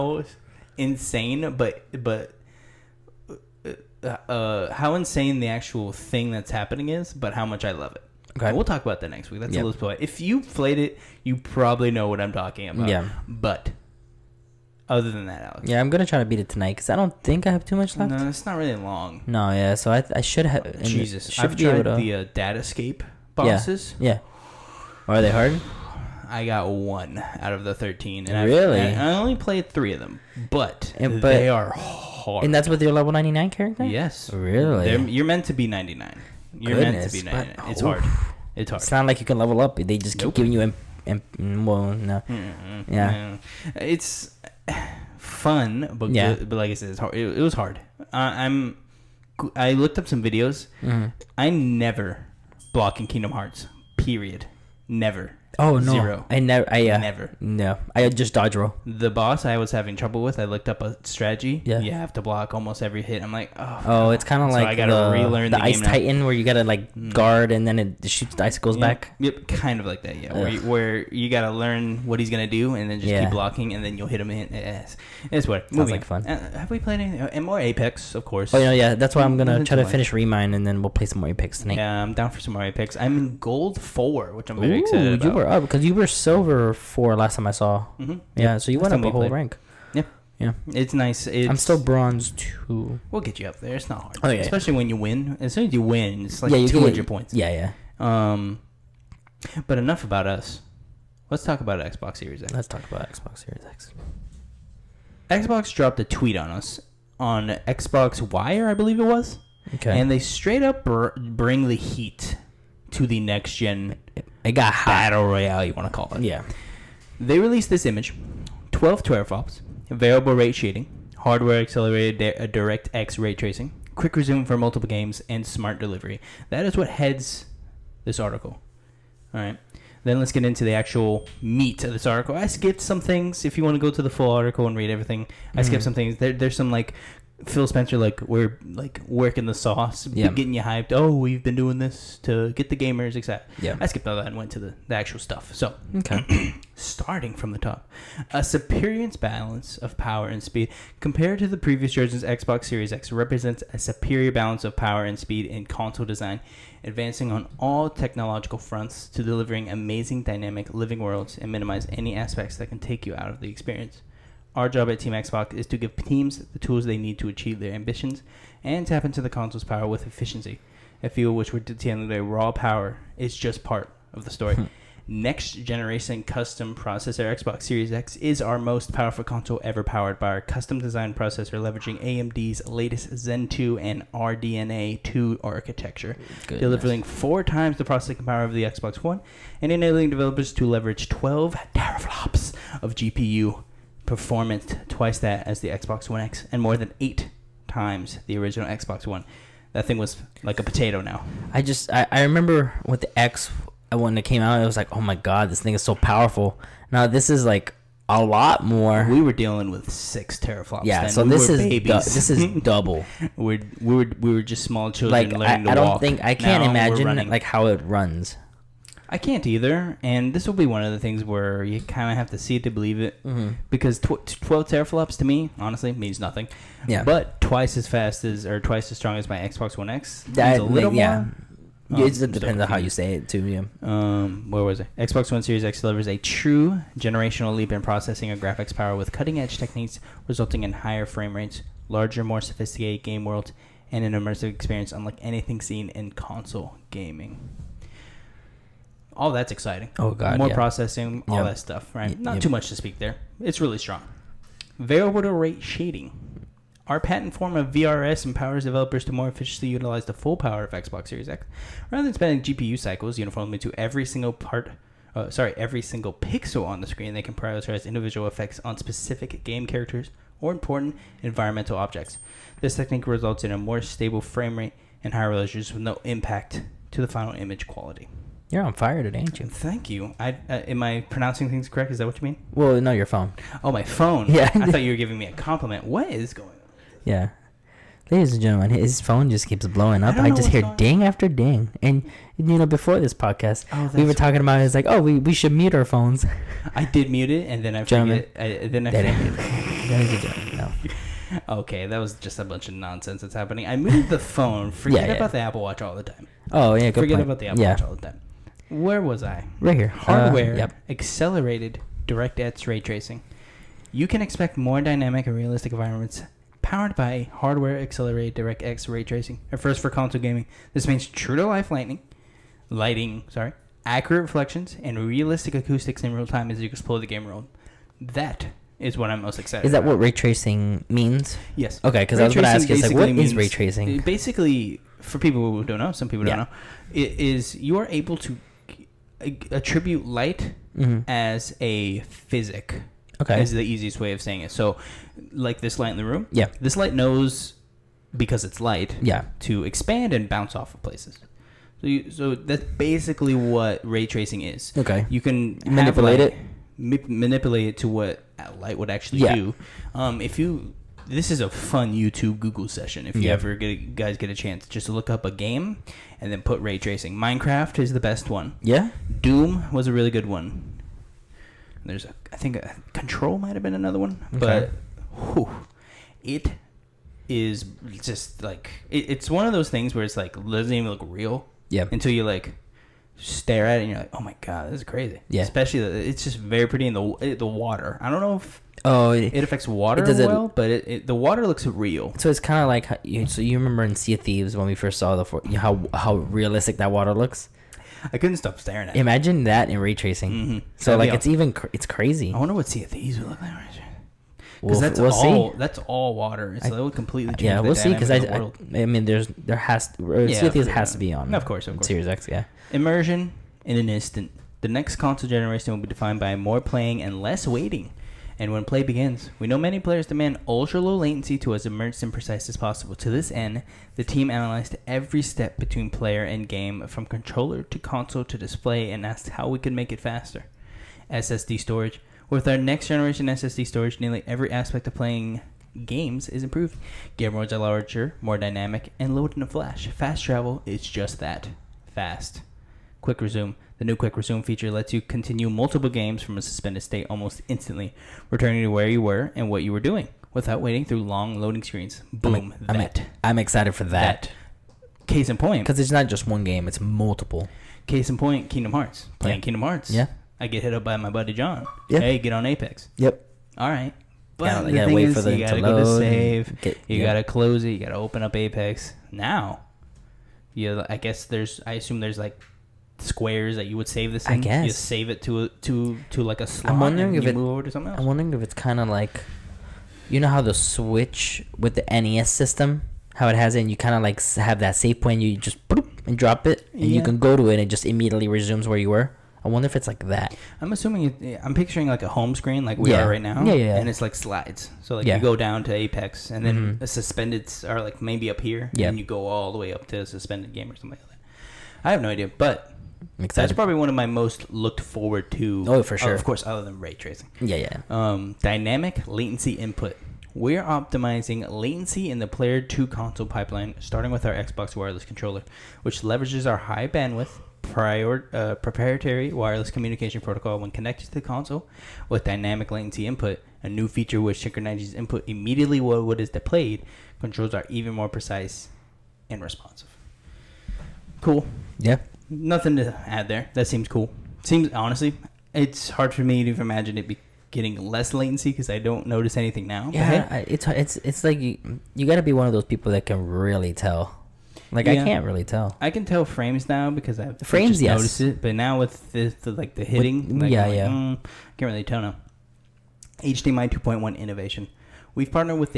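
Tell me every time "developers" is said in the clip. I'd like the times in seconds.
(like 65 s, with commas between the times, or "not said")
190 s, 258 s.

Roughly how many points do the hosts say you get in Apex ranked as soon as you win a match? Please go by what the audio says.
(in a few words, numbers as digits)
200.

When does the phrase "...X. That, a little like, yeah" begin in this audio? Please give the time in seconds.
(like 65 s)
229 s.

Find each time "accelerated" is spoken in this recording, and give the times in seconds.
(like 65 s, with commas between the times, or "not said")
121 s, 310 s, 317 s.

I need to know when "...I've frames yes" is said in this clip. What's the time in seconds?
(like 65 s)
547 s.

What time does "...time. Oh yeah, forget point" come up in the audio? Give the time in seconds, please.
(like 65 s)
306 s.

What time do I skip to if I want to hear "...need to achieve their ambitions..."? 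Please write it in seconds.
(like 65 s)
166 s.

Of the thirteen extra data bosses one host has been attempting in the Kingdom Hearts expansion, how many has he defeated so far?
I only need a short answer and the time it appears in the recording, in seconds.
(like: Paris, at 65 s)
1, at 26 s.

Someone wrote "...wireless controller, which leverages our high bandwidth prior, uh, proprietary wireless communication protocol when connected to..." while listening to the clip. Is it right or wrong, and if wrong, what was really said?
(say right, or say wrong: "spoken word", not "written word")
right.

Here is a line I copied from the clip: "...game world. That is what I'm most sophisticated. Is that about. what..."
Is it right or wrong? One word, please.
wrong.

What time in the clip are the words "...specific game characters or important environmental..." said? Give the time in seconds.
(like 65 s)
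268 s.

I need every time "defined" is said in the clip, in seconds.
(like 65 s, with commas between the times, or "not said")
415 s.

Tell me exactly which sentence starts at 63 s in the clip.
Oh, it's kind of so like I gotta the, relearn the, the Ice Titan where you gotta like mm.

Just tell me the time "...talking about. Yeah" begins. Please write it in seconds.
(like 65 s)
12 s.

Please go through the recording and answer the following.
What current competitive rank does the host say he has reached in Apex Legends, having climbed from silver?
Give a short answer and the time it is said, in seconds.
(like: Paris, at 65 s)
Gold 4, at 83 s.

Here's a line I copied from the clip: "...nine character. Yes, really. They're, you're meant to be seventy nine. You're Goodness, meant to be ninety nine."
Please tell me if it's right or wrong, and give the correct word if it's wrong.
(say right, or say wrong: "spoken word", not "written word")
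wrong: "ninety", not "seventy".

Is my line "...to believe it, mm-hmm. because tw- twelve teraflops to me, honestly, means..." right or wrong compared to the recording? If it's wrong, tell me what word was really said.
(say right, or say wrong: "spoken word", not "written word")
right.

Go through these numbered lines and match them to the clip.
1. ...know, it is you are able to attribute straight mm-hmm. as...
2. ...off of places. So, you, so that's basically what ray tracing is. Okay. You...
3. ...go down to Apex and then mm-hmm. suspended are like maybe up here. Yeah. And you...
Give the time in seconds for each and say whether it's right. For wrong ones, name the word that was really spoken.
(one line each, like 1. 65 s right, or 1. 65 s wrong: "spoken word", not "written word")
1. 336 s wrong: "light", not "straight"
2. 350 s right
3. 495 s right.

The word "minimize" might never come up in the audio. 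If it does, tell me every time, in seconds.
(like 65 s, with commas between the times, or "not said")
161 s.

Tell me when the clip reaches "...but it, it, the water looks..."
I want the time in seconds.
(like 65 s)
390 s.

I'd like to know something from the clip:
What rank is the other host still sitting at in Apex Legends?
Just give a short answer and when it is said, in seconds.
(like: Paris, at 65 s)
Bronze 2, at 91 s.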